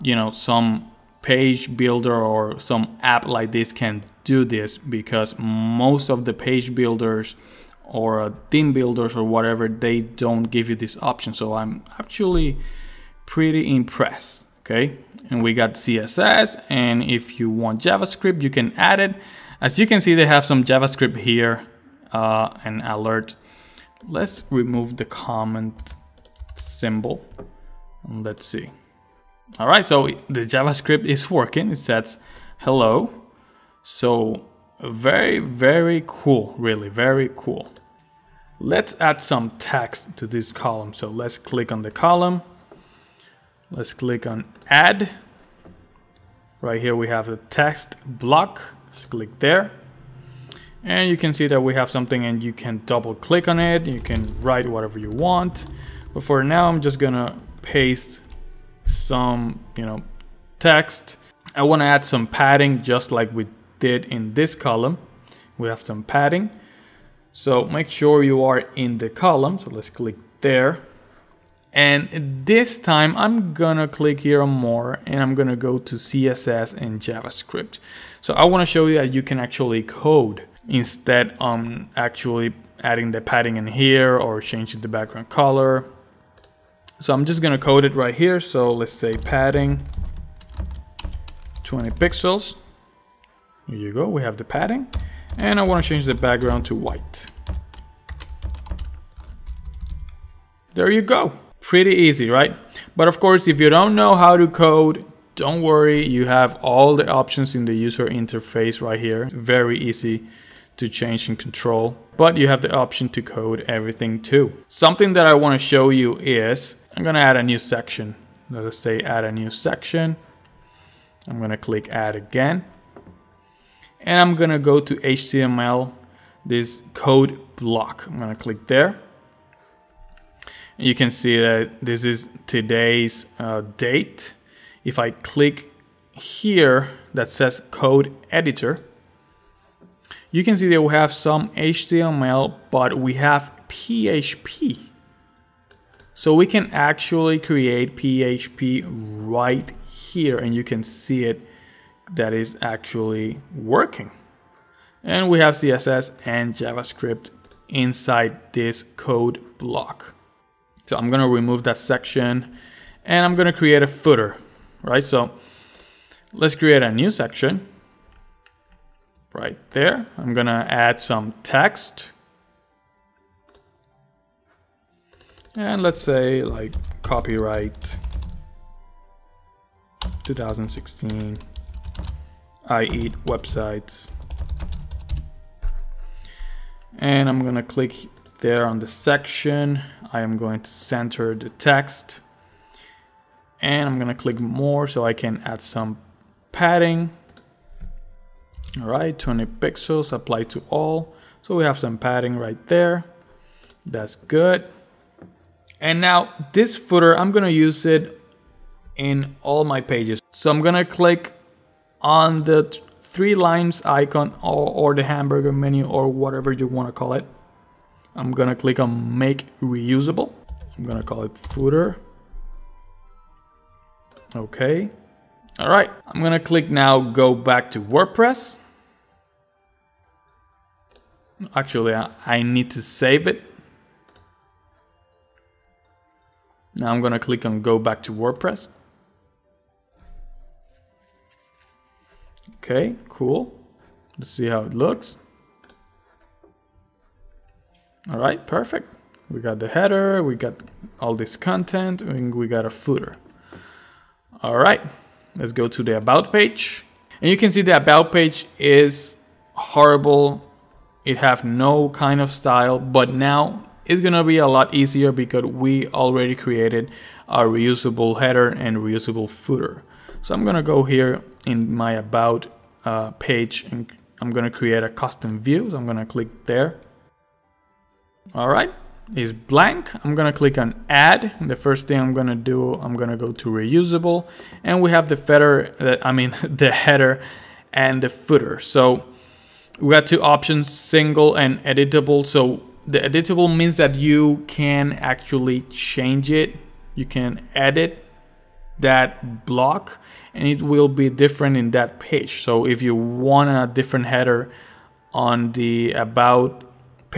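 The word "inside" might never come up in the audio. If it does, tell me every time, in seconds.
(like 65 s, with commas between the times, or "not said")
157 s.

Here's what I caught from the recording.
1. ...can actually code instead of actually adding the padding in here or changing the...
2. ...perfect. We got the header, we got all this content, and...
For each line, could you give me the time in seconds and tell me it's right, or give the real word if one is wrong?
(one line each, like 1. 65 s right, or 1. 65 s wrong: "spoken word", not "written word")
1. 79 s right
2. 248 s right.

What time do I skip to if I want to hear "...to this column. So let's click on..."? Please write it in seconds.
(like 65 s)
40 s.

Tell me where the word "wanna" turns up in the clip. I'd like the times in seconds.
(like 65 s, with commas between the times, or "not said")
61 s, 78 s.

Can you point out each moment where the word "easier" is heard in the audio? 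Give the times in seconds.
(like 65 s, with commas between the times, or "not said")
264 s.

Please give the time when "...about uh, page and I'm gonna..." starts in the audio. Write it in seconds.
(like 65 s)
271 s.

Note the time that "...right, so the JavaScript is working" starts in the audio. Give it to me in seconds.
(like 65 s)
29 s.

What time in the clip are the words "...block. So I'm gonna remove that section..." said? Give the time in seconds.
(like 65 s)
159 s.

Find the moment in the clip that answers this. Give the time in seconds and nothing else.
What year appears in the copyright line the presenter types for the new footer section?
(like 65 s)
180 s.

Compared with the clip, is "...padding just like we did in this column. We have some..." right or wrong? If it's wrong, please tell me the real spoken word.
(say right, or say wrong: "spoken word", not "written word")
right.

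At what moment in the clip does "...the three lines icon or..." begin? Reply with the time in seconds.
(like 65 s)
212 s.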